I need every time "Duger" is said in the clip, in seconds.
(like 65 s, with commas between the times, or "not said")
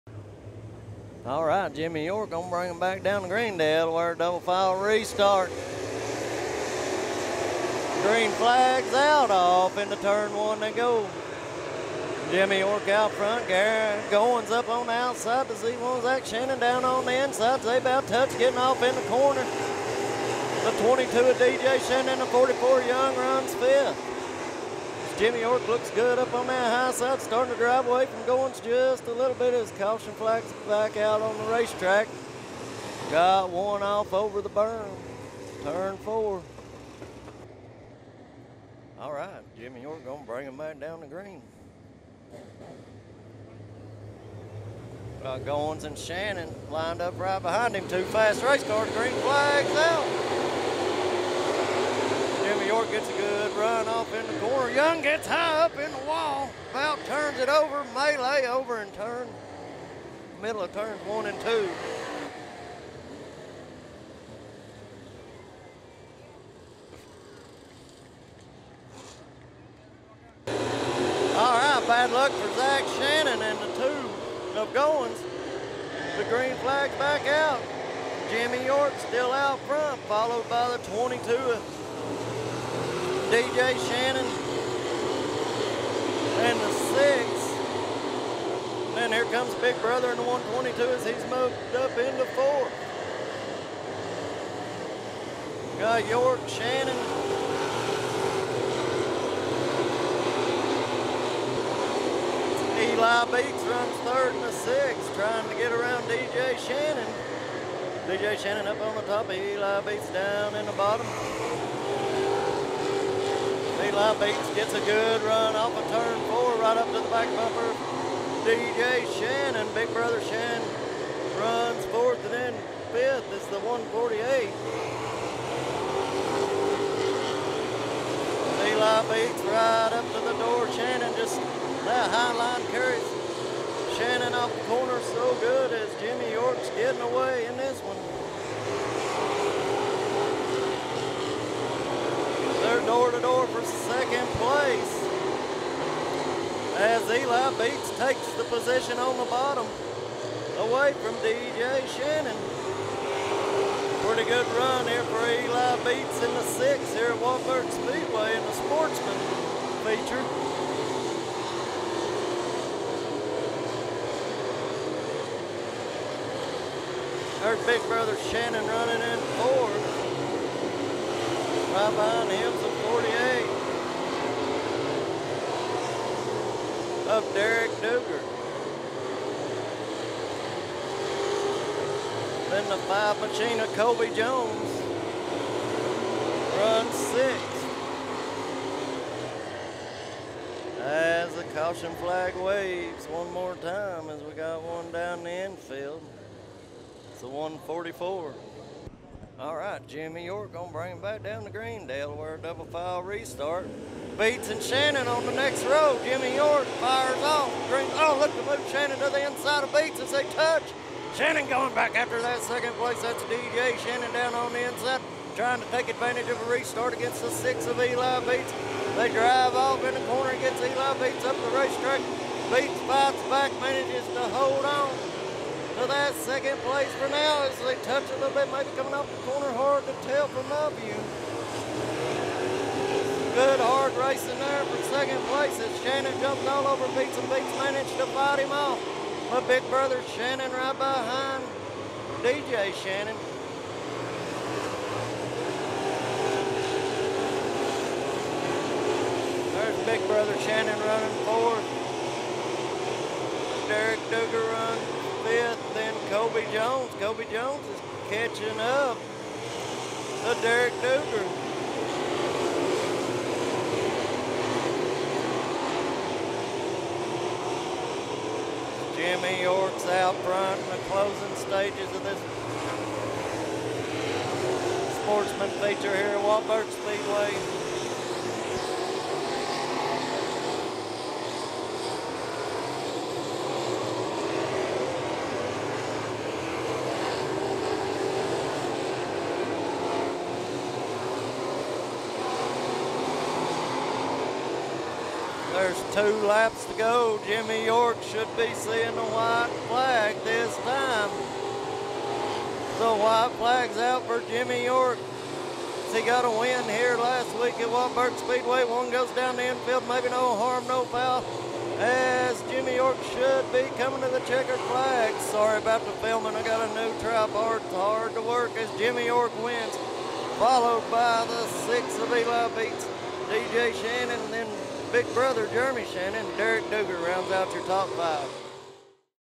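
177 s, 254 s, 260 s, 326 s.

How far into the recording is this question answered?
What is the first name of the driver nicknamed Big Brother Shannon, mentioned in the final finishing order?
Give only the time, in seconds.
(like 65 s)
325 s.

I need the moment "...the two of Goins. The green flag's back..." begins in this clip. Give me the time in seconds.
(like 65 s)
73 s.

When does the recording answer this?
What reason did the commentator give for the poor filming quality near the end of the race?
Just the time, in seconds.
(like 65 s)
316 s.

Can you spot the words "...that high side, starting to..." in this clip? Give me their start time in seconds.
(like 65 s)
26 s.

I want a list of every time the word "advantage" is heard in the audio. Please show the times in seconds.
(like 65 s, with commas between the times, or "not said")
215 s.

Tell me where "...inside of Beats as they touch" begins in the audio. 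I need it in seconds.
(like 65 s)
209 s.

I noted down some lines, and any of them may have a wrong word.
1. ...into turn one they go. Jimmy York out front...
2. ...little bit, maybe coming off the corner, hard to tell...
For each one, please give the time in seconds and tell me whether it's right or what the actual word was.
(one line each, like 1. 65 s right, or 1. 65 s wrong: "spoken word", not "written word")
1. 9 s right
2. 228 s right.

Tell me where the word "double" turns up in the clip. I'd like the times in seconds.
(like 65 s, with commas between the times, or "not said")
4 s, 202 s.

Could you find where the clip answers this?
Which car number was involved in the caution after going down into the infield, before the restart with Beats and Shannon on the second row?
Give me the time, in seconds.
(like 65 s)
197 s.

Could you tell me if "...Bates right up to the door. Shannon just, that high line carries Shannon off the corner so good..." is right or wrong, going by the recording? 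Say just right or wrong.
right.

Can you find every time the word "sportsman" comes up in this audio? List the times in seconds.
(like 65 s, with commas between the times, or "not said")
158 s, 275 s.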